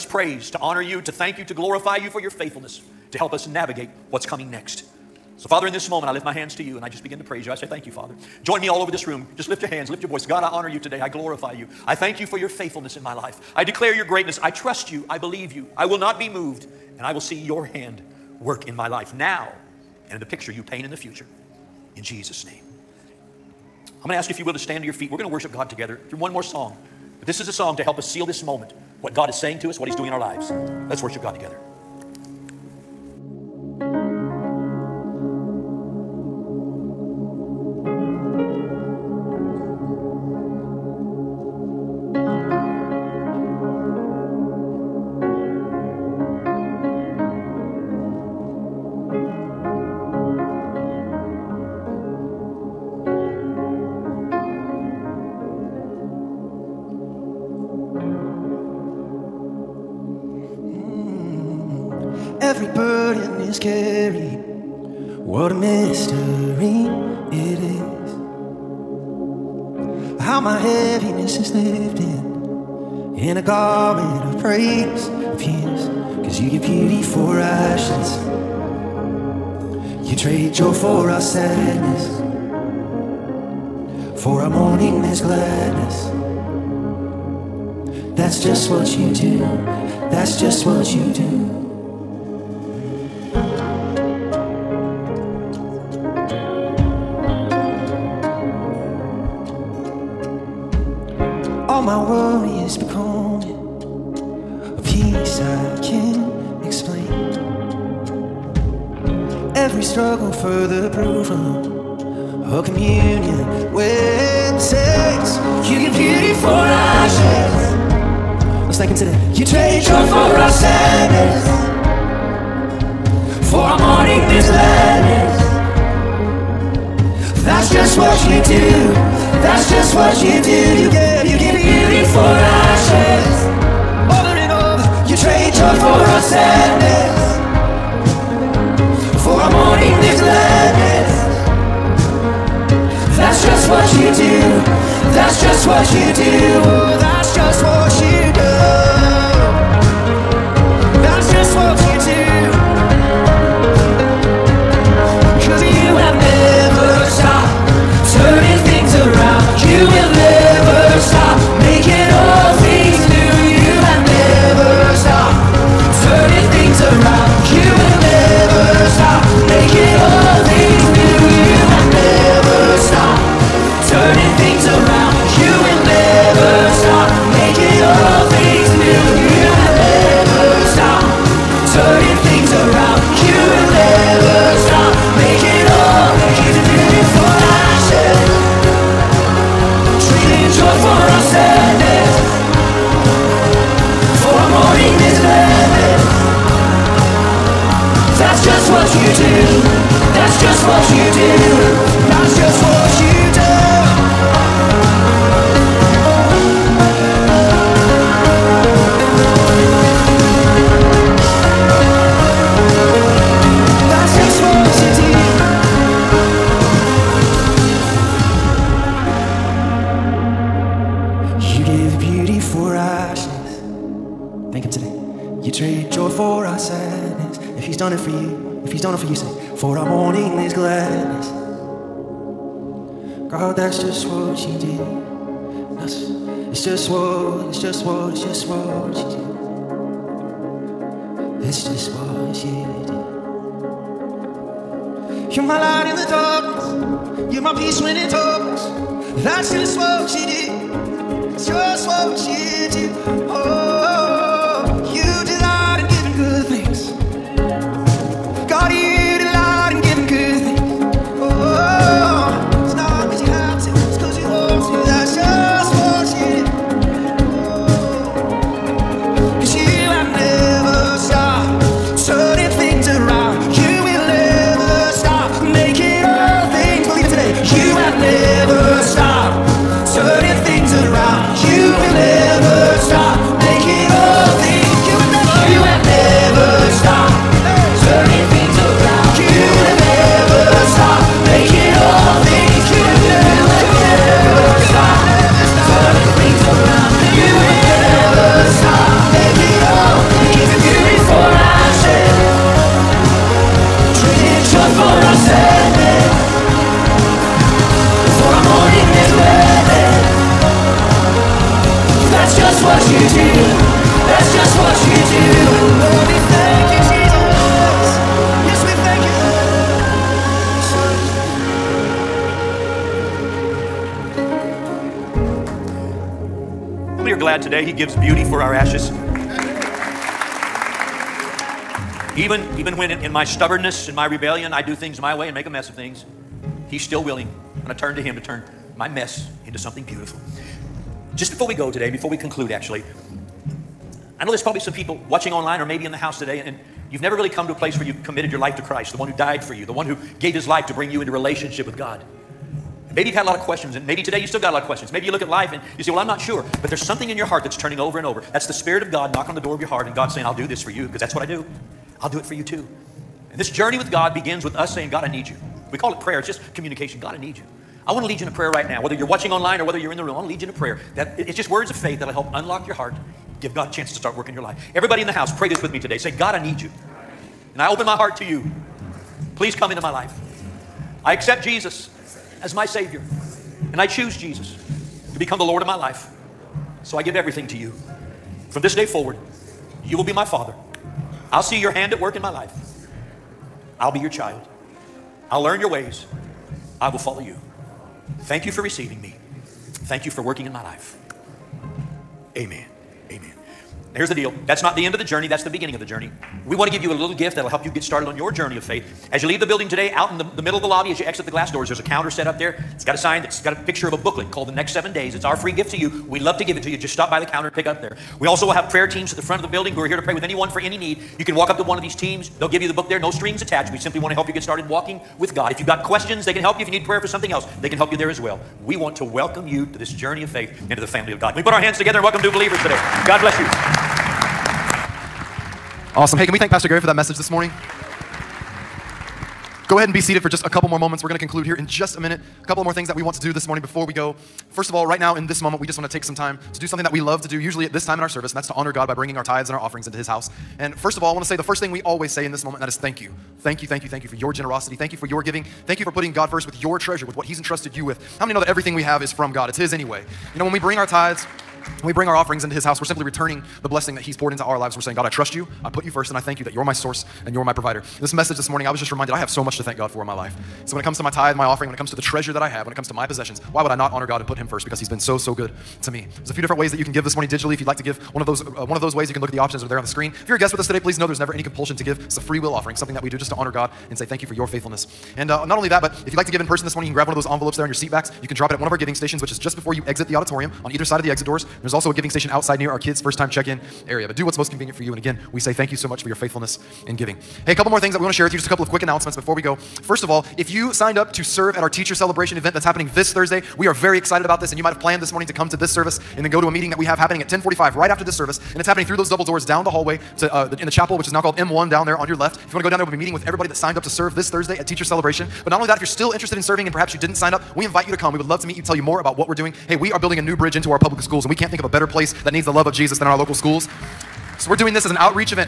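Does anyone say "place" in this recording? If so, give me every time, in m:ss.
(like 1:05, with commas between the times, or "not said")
5:47, 8:41.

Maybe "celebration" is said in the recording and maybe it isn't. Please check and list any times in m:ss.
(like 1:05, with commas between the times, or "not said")
8:21, 8:34.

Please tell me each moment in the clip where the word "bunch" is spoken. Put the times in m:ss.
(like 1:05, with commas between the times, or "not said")
not said.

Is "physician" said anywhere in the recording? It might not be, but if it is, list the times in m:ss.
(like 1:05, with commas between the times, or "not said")
not said.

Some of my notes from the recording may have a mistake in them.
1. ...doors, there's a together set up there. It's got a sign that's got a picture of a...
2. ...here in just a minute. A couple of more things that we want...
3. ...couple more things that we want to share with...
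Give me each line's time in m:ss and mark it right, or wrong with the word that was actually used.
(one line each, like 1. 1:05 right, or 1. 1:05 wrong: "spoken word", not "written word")
1. 6:51 wrong: "counter", not "together"
2. 7:21 right
3. 8:17 right.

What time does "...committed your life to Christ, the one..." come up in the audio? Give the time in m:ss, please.
5:48.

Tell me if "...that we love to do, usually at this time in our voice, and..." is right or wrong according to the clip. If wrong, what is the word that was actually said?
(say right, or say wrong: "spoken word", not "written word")
wrong: "service", not "voice".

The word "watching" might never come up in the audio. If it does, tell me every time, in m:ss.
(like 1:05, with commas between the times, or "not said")
5:45, 6:09.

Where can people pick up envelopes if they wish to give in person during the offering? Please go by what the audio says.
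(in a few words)
seat backs.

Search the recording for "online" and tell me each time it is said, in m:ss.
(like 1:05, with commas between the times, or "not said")
5:45, 6:09.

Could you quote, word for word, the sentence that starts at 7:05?
If you've got questions, they can help you.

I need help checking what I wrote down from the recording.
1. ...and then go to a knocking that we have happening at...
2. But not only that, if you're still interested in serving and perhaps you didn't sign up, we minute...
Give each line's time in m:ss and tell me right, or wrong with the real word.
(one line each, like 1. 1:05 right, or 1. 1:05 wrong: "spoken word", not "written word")
1. 8:26 wrong: "meeting", not "knocking"
2. 8:35 wrong: "invite", not "minute".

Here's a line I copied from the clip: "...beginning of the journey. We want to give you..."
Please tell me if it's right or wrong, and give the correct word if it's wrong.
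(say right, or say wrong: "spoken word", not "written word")
right.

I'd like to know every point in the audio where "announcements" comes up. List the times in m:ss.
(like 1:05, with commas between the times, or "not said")
8:18.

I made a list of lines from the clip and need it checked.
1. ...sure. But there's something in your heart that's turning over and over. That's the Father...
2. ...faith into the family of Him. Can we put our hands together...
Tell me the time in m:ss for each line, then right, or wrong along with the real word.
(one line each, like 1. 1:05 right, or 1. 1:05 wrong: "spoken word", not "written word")
1. 5:56 wrong: "Spirit", not "Father"
2. 7:10 wrong: "God", not "Him".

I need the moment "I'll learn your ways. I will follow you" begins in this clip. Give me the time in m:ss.
6:35.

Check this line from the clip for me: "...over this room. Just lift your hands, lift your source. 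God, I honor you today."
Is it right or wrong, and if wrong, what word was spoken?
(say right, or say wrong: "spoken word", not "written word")
wrong: "voice", not "source".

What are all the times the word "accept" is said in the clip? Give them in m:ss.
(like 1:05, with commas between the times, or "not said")
6:21.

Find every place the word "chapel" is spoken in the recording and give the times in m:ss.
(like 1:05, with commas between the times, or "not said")
8:30.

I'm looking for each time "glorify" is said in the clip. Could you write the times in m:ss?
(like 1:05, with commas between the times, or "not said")
0:01, 0:11.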